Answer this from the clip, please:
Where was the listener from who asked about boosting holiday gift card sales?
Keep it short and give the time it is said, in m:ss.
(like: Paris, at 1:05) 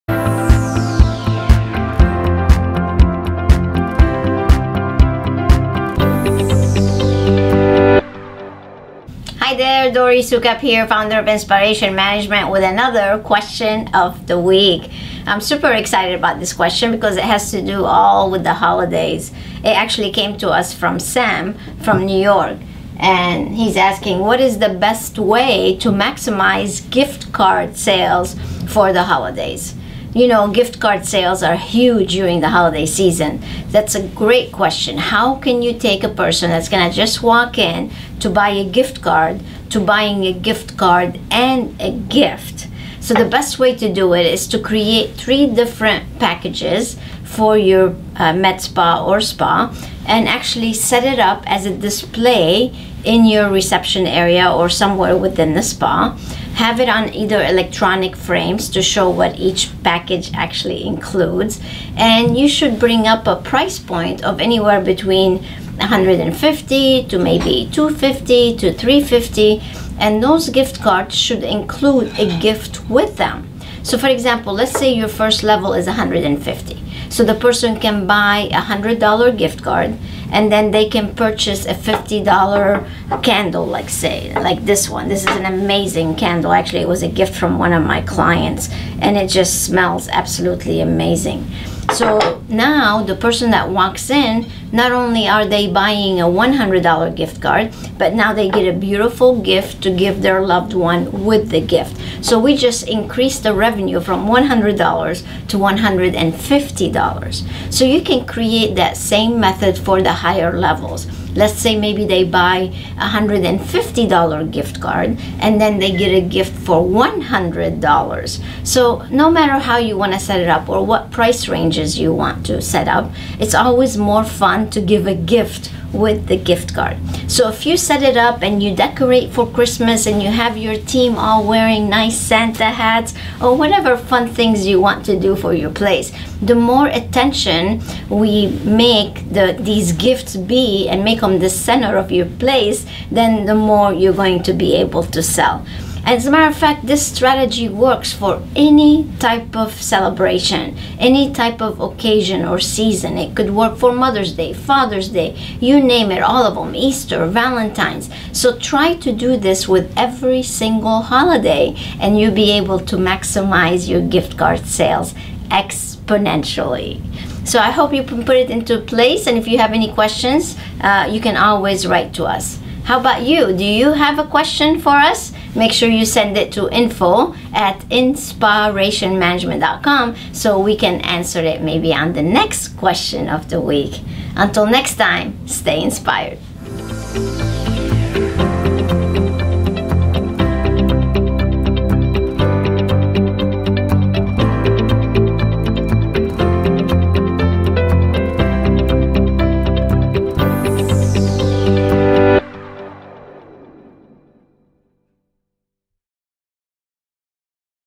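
New York, at 0:22.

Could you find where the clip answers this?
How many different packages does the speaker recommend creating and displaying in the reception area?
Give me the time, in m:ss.
0:45.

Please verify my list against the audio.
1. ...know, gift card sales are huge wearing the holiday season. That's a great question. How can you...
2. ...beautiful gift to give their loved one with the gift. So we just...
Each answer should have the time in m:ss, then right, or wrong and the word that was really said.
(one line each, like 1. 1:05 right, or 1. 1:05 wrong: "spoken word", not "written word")
1. 0:30 wrong: "during", not "wearing"
2. 1:38 right.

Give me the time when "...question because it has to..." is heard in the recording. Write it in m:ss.
0:16.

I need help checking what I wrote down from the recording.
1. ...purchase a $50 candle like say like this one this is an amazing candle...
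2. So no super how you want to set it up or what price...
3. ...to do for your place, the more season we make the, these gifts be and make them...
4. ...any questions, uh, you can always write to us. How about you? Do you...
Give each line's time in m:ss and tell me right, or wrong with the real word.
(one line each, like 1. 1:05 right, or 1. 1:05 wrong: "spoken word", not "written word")
1. 1:21 right
2. 1:58 wrong: "matter", not "super"
3. 2:15 wrong: "attention", not "season"
4. 2:49 right.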